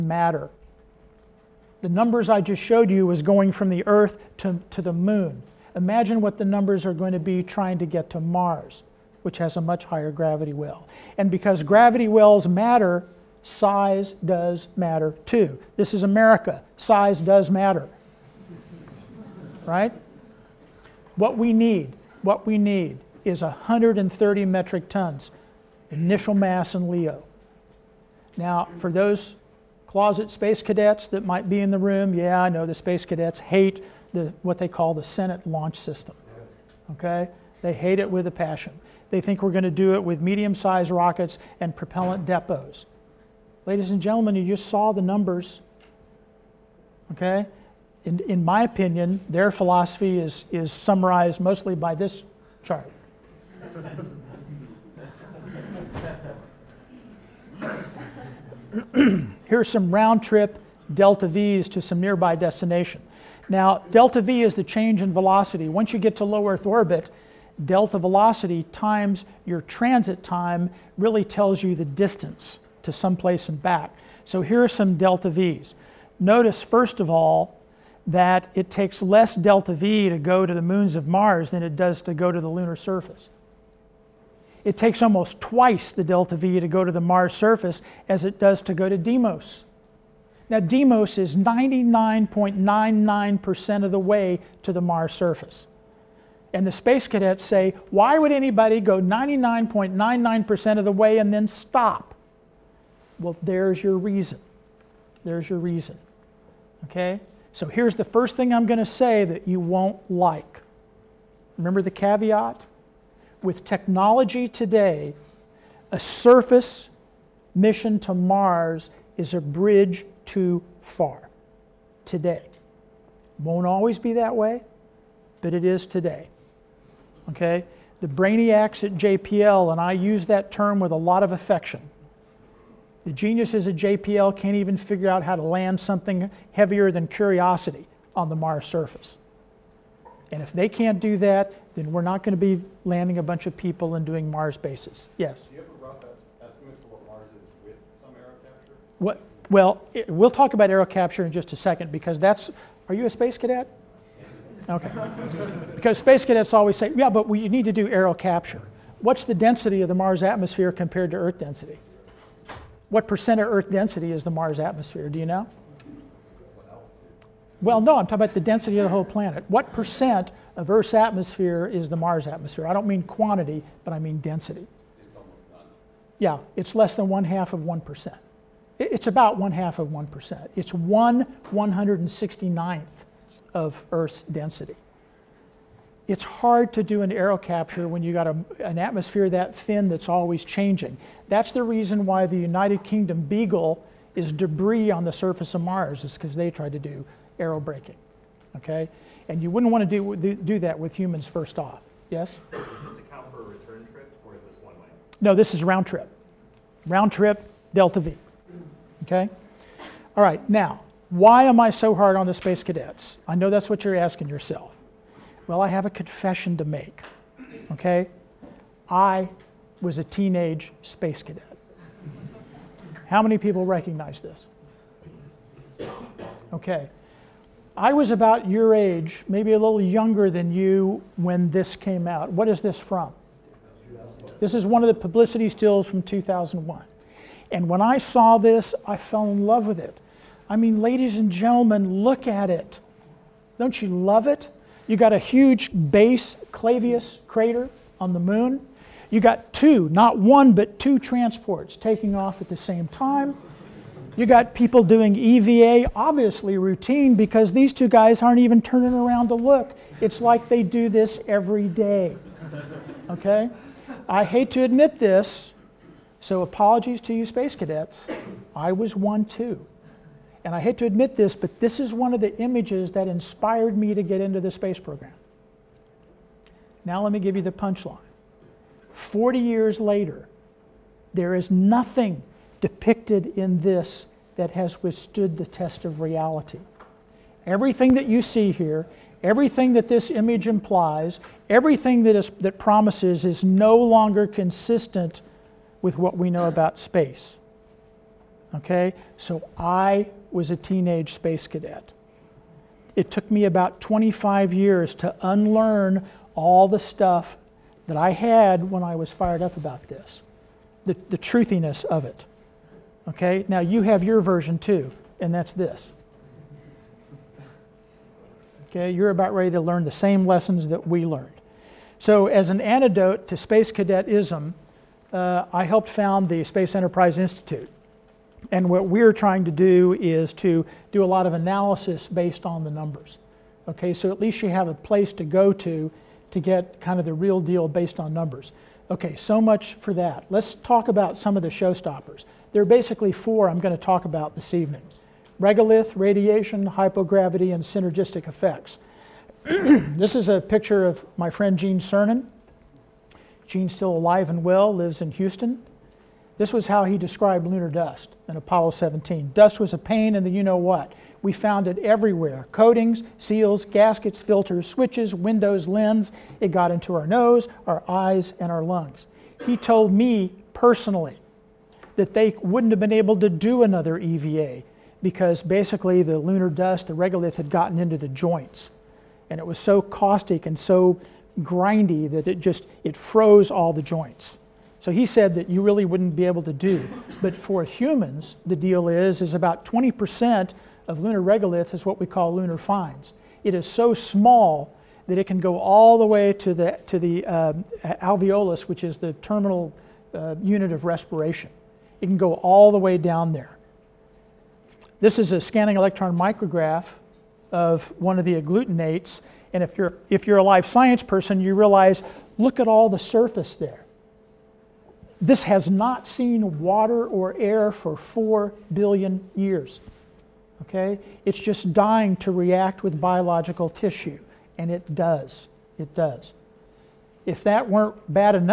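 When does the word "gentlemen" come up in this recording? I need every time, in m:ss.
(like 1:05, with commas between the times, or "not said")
0:44, 4:01.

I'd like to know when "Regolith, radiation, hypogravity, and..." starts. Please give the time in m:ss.
5:45.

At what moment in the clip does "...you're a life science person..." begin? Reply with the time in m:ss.
6:50.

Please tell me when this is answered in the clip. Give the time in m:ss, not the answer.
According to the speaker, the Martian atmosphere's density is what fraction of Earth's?
3:00.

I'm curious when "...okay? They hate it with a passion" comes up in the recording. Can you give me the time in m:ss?
0:36.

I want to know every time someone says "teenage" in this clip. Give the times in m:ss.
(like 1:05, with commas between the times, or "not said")
3:40, 5:00.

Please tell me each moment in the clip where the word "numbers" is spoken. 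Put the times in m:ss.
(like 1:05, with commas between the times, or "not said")
0:01, 0:06, 0:45, 5:32, 5:38.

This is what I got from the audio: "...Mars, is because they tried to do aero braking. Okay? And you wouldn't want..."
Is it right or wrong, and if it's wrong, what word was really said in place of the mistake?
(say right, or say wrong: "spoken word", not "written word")
right.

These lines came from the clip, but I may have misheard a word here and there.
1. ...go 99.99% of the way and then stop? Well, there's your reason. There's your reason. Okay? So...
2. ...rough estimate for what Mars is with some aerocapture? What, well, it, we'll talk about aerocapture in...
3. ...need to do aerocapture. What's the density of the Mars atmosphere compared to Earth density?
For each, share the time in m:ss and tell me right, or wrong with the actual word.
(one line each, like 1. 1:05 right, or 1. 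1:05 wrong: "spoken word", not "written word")
1. 1:38 right
2. 2:25 right
3. 2:37 right.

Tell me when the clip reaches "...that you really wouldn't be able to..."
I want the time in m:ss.
6:25.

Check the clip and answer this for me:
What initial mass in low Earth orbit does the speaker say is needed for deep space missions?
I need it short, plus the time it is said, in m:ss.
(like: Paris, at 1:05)
130 metric tons, at 0:23.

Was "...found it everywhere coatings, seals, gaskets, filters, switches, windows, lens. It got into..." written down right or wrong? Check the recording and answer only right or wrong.
right.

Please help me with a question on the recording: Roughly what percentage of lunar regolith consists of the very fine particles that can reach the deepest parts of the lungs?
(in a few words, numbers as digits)
20%.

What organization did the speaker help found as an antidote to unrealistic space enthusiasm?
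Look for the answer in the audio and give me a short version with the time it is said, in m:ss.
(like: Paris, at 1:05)
Space Enterprise Institute, at 5:26.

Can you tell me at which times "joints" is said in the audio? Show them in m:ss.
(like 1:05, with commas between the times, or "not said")
6:18, 6:23.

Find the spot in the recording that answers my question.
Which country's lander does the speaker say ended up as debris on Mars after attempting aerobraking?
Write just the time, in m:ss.
3:12.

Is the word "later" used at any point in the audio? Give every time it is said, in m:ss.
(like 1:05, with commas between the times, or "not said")
4:39.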